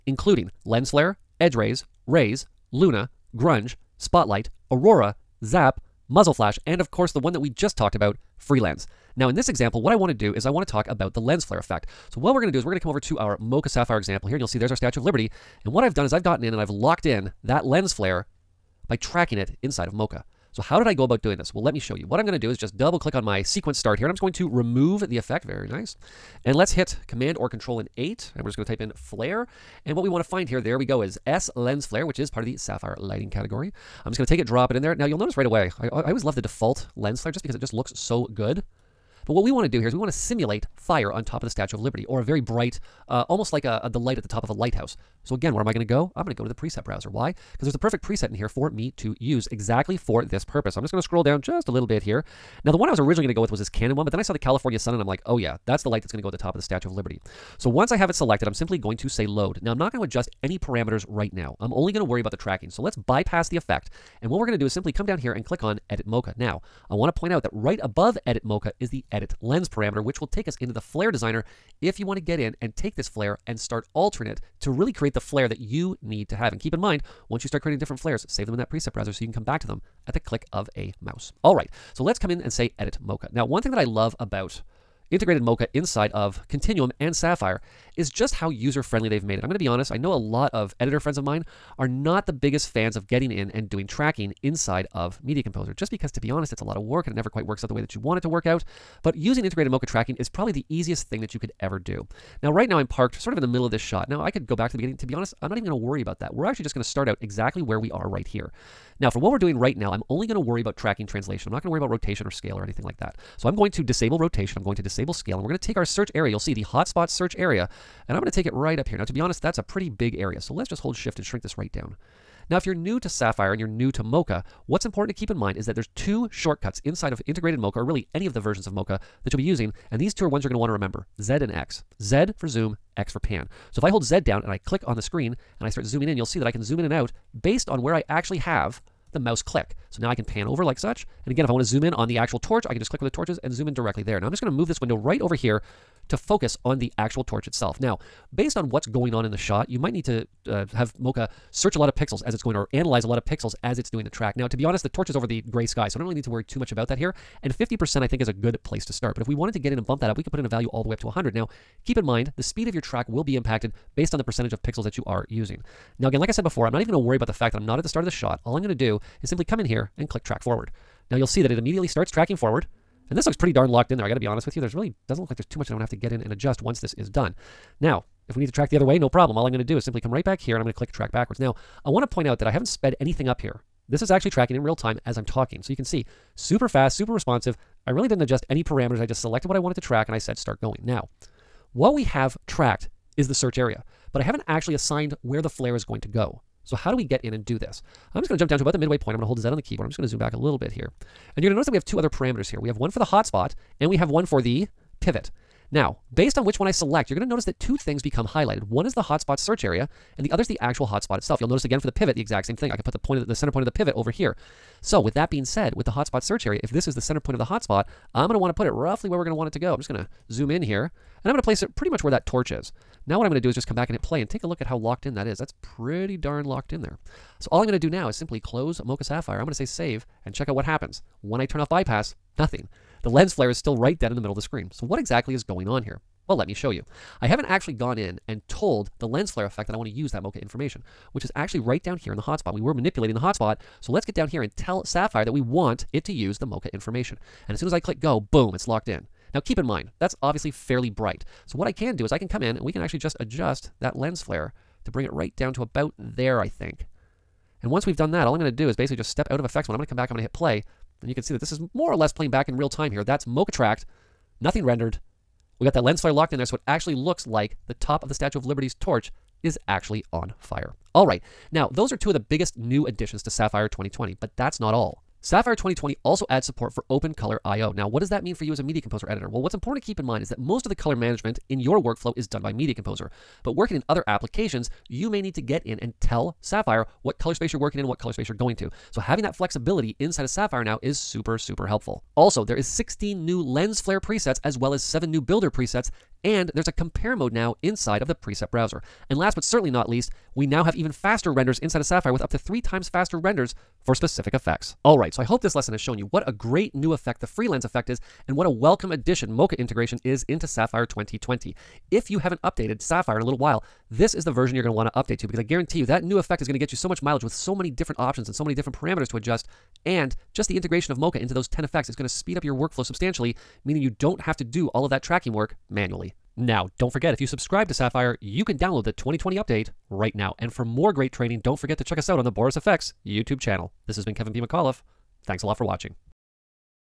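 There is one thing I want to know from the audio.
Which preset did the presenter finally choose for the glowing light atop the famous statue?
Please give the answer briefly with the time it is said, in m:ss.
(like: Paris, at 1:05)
California sun, at 0:54.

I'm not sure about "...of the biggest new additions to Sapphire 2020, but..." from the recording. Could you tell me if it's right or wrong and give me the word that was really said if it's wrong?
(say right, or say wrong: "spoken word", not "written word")
right.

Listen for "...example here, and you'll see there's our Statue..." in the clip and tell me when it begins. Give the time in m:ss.
0:13.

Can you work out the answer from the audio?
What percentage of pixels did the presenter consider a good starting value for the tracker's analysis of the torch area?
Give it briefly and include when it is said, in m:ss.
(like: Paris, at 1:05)
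50%, at 2:37.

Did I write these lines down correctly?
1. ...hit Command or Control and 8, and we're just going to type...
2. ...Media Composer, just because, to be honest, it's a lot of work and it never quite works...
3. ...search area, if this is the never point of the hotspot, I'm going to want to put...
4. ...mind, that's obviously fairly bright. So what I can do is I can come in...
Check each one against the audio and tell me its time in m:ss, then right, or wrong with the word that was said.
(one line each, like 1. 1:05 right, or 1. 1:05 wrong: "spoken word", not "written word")
1. 0:26 right
2. 1:35 right
3. 3:36 wrong: "center", not "never"
4. 4:09 right.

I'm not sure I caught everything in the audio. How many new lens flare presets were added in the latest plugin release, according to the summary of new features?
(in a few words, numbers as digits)
16.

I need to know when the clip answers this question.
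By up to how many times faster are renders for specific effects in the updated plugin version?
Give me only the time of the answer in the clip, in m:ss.
5:02.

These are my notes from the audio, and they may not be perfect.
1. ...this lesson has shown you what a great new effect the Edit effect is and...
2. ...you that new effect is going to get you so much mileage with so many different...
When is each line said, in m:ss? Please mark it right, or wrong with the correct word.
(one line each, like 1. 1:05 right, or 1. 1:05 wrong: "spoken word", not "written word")
1. 5:05 wrong: "FreeLens", not "Edit"
2. 5:15 right.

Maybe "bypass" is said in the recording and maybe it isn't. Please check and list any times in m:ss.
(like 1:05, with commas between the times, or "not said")
1:02, 3:51.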